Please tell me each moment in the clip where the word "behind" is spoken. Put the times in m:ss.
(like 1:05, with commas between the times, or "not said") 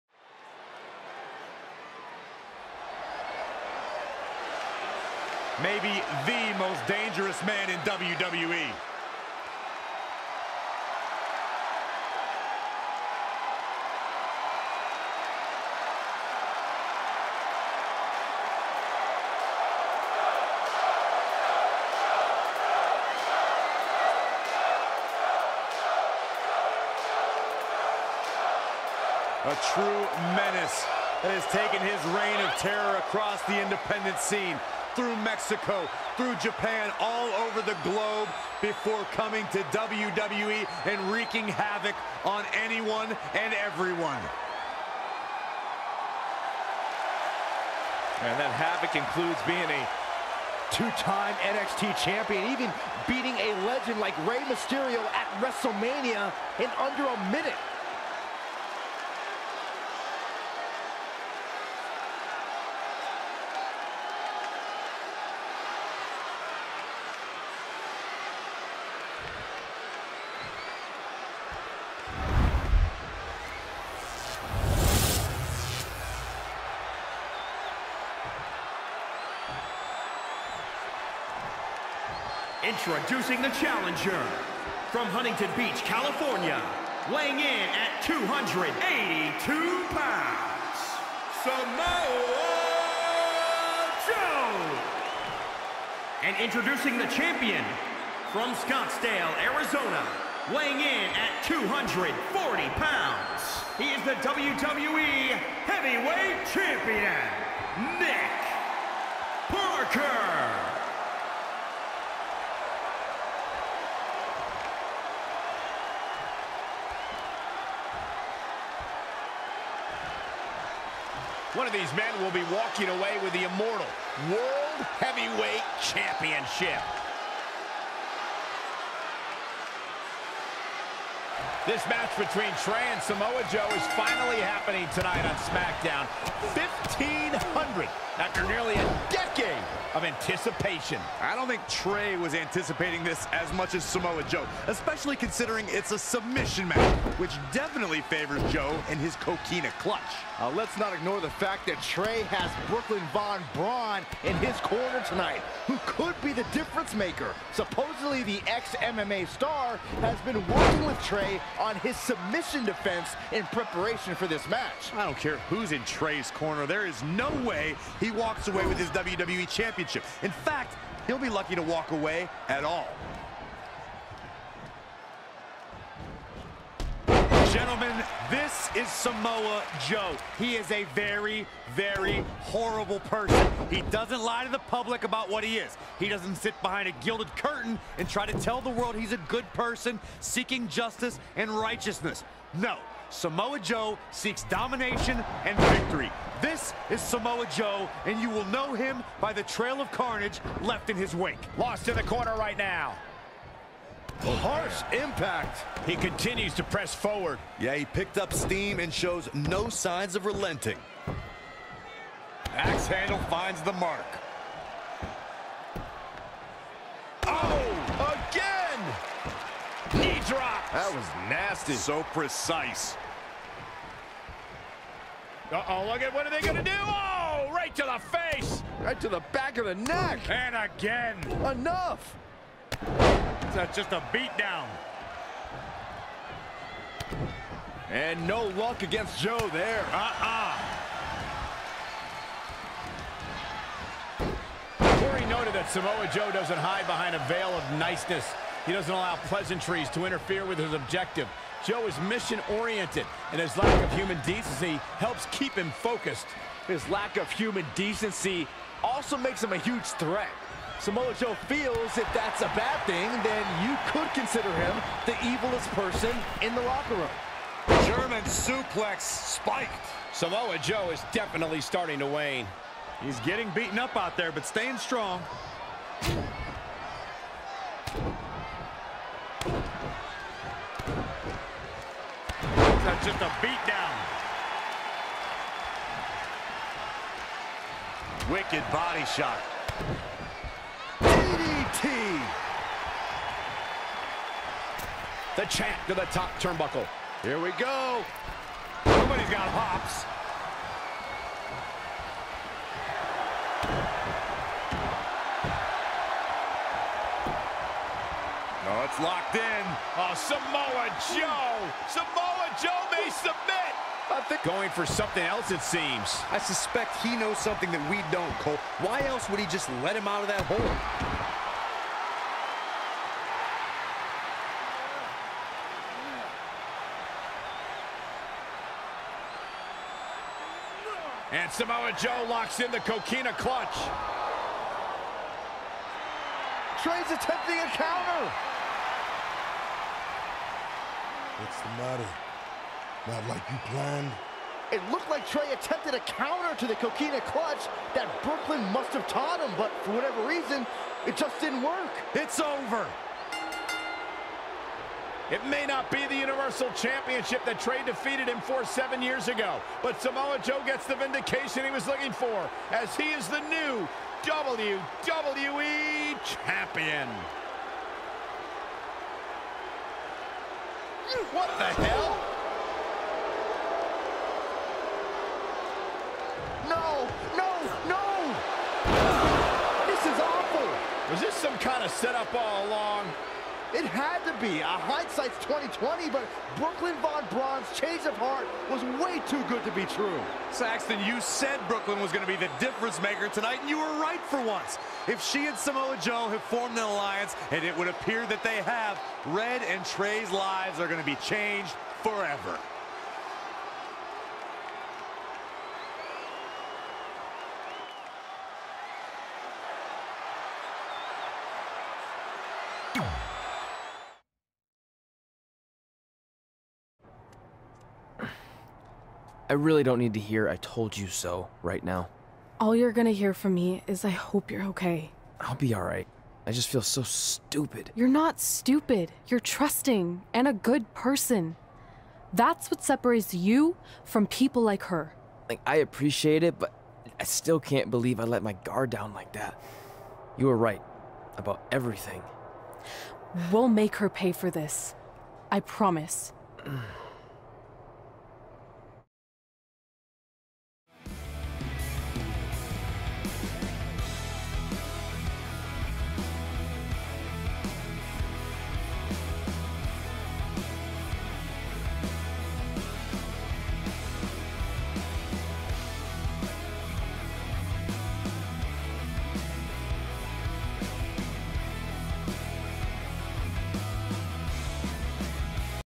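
3:06, 4:06.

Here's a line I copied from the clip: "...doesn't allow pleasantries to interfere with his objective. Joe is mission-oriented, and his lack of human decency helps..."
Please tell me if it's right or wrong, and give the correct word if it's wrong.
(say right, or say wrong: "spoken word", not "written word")
right.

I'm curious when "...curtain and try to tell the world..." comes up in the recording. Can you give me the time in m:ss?
3:07.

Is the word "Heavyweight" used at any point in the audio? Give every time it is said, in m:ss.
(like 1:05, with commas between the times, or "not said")
1:45, 2:05.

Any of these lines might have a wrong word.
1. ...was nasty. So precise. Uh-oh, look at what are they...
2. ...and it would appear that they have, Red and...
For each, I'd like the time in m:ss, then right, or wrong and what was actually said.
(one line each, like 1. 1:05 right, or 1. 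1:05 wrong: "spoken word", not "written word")
1. 3:40 right
2. 6:37 right.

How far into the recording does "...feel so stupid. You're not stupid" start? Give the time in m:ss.
7:06.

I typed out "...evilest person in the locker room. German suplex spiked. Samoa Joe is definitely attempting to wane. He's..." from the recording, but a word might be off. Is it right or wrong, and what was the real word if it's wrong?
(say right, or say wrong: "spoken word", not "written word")
wrong: "starting", not "attempting".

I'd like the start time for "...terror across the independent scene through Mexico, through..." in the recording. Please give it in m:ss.
0:32.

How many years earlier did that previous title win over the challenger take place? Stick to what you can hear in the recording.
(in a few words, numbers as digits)
7.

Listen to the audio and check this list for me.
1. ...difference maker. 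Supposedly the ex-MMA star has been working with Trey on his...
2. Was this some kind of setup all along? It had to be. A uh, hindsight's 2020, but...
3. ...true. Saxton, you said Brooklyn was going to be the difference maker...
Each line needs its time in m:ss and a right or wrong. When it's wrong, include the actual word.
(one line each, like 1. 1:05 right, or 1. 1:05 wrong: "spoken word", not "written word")
1. 2:36 right
2. 6:21 right
3. 6:29 right.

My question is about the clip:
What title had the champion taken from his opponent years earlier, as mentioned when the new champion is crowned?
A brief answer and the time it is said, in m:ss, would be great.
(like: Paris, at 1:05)
Universal Championship, at 5:56.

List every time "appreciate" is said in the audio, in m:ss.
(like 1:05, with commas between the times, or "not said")
7:15.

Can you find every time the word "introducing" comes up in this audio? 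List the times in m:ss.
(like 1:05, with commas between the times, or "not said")
1:22, 1:36.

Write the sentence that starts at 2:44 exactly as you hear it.
I don't care who's in Trey's corner.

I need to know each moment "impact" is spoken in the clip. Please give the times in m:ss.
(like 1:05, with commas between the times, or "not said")
3:24.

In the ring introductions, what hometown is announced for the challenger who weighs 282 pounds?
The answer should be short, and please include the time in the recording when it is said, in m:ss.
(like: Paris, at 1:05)
Huntington Beach, California, at 1:25.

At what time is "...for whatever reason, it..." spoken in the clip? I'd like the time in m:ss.
5:49.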